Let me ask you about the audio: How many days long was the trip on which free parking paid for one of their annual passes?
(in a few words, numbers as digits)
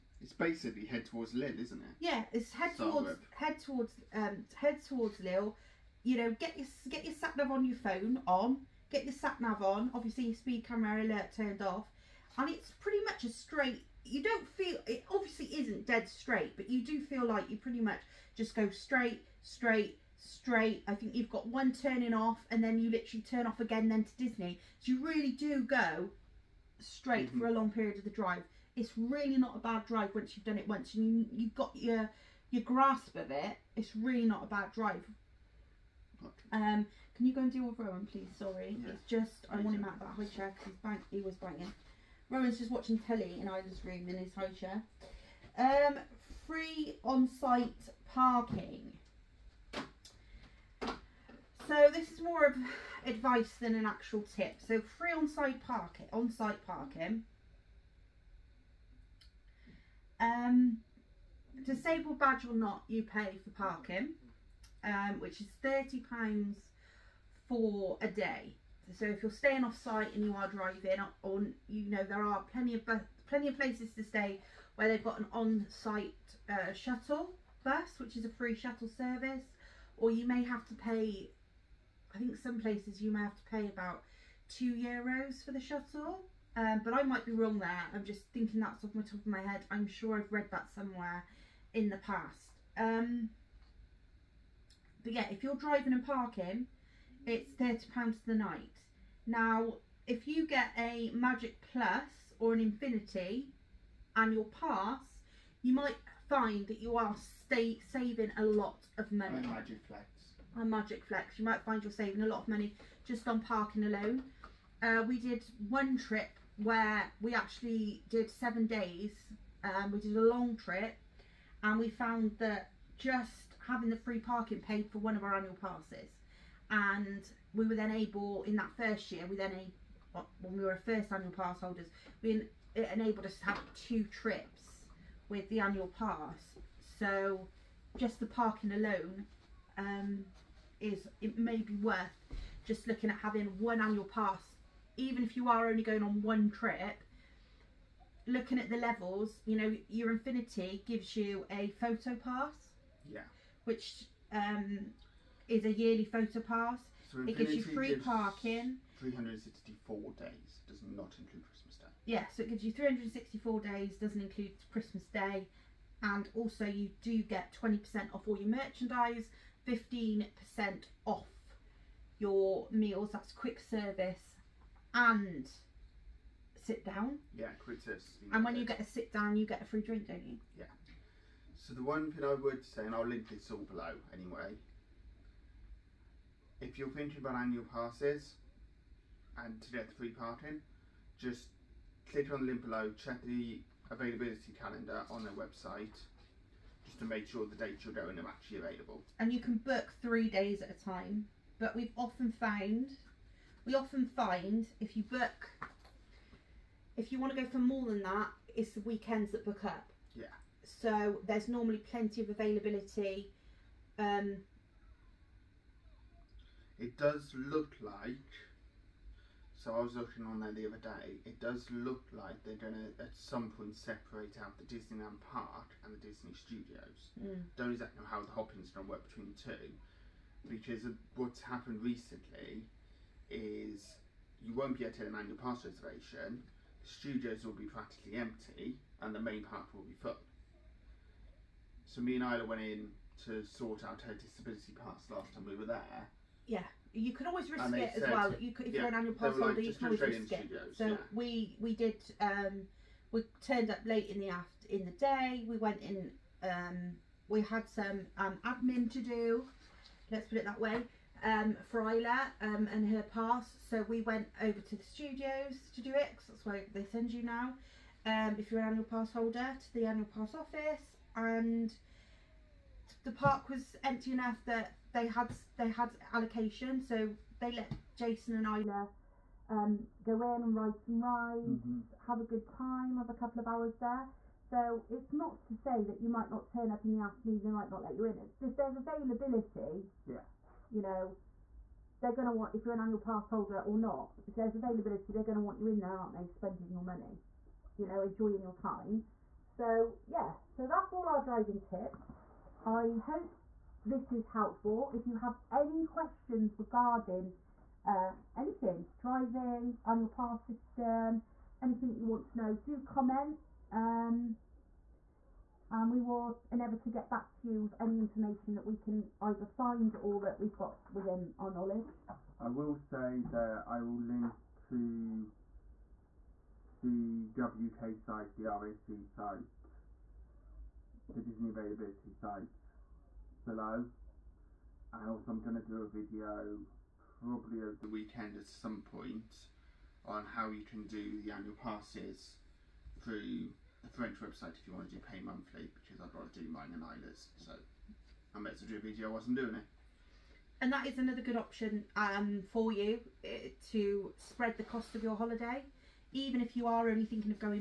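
7 days.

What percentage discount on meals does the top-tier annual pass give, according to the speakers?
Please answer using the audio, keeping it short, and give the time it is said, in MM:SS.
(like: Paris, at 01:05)
15%, at 02:49.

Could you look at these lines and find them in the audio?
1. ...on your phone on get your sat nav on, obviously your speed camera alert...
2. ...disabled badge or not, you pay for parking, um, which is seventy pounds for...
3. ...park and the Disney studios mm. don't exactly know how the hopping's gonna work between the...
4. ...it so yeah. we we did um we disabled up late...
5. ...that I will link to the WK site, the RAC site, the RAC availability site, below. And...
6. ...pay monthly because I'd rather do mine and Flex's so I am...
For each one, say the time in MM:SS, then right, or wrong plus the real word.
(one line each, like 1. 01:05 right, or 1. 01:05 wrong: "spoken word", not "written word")
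1. 00:07 right
2. 01:01 wrong: "thirty", not "seventy"
3. 03:45 right
4. 04:10 wrong: "turned", not "disabled"
5. 05:23 wrong: "Disney", not "RAC"
6. 05:45 wrong: "Isla", not "Flex".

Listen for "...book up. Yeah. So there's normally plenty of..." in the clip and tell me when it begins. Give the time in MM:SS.
03:29.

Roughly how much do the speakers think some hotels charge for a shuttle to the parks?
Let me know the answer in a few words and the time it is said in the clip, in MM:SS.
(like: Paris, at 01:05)
2 euros, at 01:24.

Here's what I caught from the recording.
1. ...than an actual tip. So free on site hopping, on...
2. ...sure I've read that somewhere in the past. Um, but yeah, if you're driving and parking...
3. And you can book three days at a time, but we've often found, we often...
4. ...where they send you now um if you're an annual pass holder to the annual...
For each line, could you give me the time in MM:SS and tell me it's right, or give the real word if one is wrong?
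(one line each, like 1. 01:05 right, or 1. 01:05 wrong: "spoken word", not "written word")
1. 00:53 wrong: "parking", not "hopping"
2. 01:29 right
3. 03:19 right
4. 04:26 right.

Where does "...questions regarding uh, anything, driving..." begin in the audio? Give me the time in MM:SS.
05:05.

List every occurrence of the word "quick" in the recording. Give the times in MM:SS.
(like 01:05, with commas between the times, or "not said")
02:53, 02:57.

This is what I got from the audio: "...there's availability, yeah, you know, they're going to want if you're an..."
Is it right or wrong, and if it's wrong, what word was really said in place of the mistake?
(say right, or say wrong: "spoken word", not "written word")
right.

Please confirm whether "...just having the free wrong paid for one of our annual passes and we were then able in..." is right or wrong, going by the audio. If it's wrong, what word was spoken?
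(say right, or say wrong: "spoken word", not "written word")
wrong: "parking", not "wrong".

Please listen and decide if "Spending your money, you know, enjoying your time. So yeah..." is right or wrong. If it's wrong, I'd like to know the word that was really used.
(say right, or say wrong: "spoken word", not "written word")
right.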